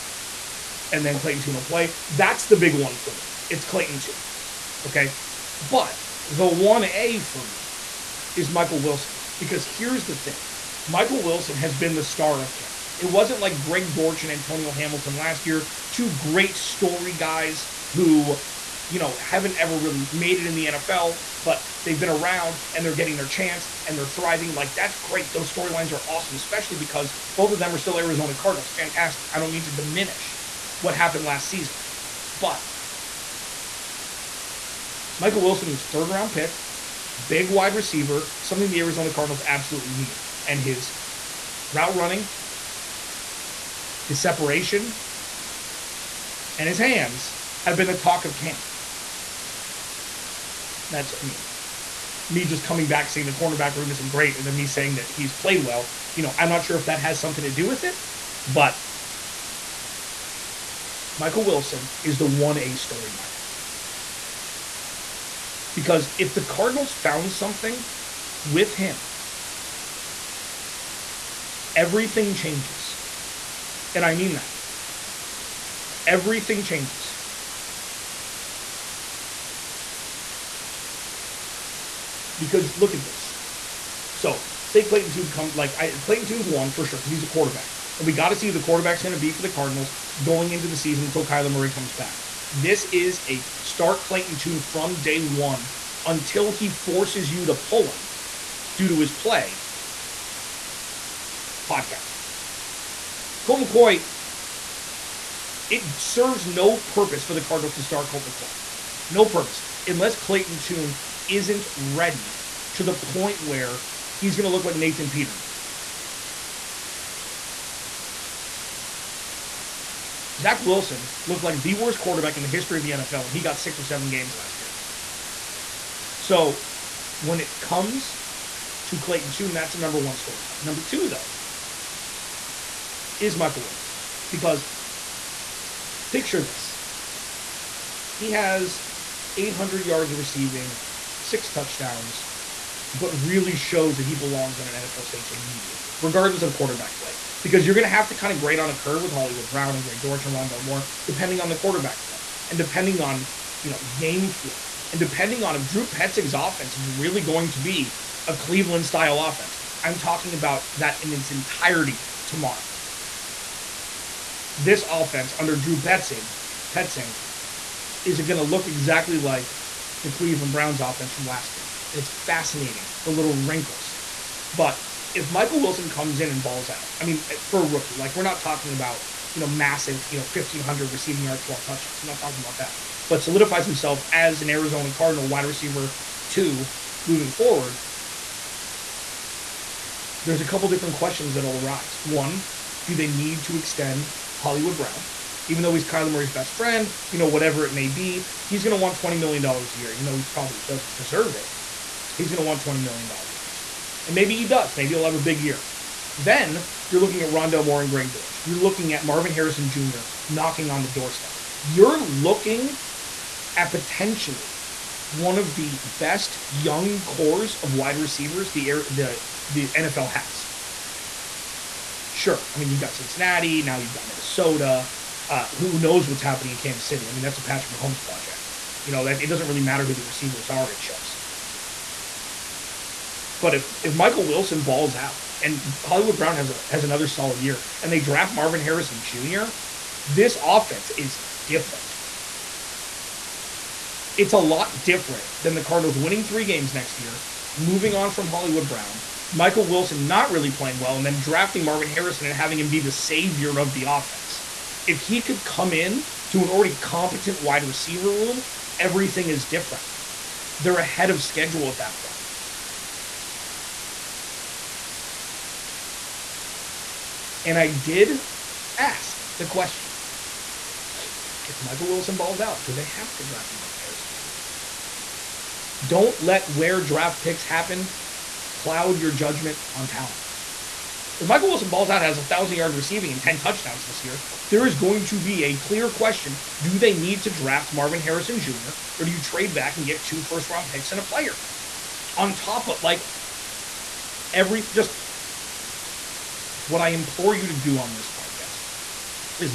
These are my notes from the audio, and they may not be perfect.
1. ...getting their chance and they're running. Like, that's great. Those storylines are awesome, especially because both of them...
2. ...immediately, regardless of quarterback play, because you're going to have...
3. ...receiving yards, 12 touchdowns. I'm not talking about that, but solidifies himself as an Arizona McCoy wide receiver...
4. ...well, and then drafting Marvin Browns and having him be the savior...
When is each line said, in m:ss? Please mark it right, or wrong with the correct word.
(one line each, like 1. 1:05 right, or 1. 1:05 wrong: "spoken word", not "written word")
1. 0:22 wrong: "thriving", not "running"
2. 2:25 right
3. 3:00 wrong: "Cardinal", not "McCoy"
4. 4:10 wrong: "Harrison", not "Browns".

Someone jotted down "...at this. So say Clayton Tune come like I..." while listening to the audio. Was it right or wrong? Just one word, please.
right.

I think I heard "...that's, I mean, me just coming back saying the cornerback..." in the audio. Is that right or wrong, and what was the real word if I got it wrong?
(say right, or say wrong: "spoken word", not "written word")
right.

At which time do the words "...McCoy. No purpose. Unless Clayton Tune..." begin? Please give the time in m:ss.
1:48.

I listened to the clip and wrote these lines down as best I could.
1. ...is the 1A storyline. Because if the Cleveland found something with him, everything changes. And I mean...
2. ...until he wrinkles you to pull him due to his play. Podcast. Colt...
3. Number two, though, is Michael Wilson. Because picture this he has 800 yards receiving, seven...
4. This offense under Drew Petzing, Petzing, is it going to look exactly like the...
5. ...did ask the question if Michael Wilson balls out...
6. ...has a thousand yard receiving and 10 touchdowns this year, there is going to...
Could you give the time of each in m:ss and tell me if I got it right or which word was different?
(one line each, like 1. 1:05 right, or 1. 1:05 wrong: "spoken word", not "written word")
1. 1:02 wrong: "Cardinals", not "Cleveland"
2. 1:36 wrong: "forces", not "wrinkles"
3. 2:10 wrong: "six", not "seven"
4. 2:44 right
5. 4:27 right
6. 4:42 right.